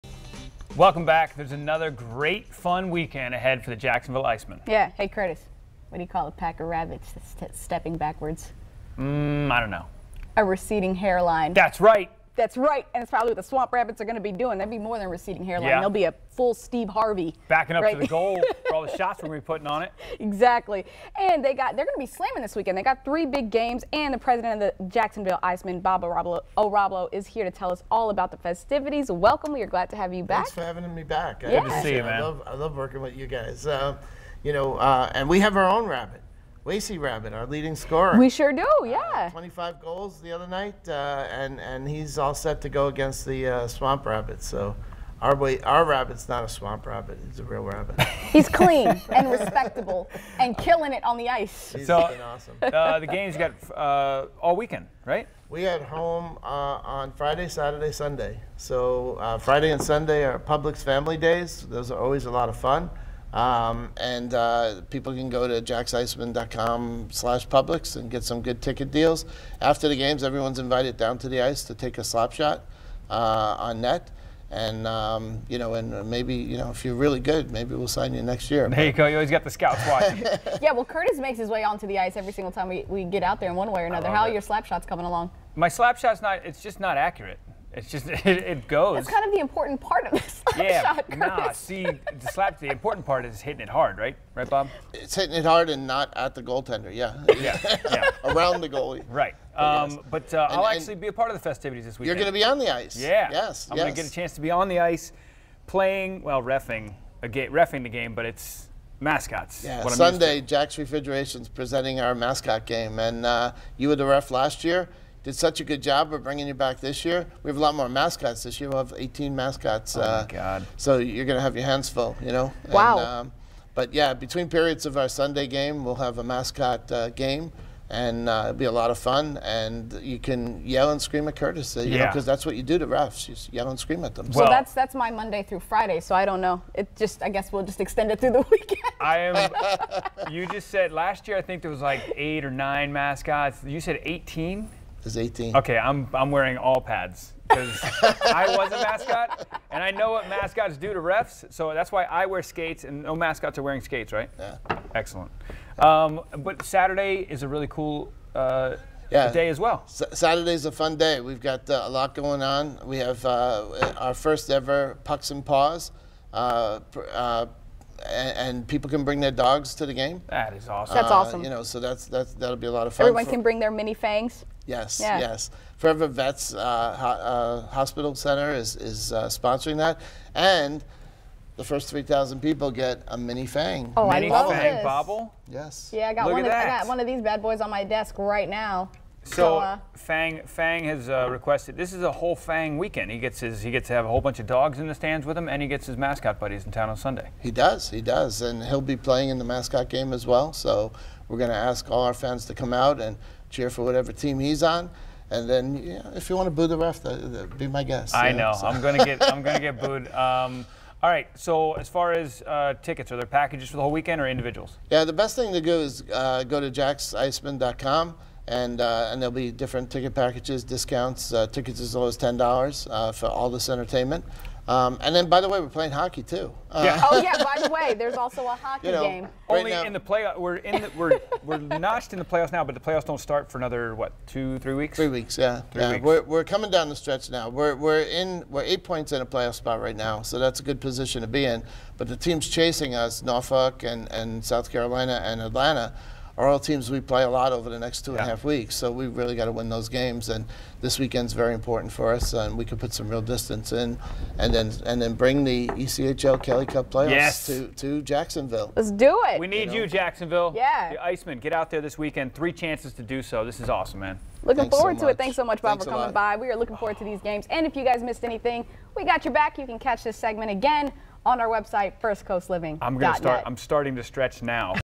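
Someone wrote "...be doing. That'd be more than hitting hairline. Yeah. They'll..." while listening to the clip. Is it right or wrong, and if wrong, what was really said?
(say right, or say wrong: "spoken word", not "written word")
wrong: "receding", not "hitting".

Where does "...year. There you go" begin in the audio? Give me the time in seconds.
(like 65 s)
78 s.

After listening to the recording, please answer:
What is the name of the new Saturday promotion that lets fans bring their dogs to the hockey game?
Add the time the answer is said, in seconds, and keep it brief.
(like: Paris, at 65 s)
Pucks and Paws, at 165 s.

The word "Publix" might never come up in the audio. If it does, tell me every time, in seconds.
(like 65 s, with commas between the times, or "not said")
60 s, 67 s.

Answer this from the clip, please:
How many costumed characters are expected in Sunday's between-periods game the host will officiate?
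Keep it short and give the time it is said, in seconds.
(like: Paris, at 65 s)
18, at 118 s.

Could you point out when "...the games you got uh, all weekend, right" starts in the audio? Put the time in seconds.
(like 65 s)
52 s.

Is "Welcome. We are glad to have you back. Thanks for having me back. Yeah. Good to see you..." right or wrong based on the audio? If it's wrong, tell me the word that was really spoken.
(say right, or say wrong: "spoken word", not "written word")
right.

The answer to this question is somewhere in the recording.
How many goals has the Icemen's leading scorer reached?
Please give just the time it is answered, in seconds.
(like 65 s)
39 s.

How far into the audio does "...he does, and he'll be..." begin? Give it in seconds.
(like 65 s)
197 s.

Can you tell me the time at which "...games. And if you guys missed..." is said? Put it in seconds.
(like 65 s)
267 s.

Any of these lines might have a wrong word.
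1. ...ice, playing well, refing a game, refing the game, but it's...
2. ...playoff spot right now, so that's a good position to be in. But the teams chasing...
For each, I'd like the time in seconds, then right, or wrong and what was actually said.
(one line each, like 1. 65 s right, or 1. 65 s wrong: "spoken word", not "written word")
1. 104 s right
2. 239 s right.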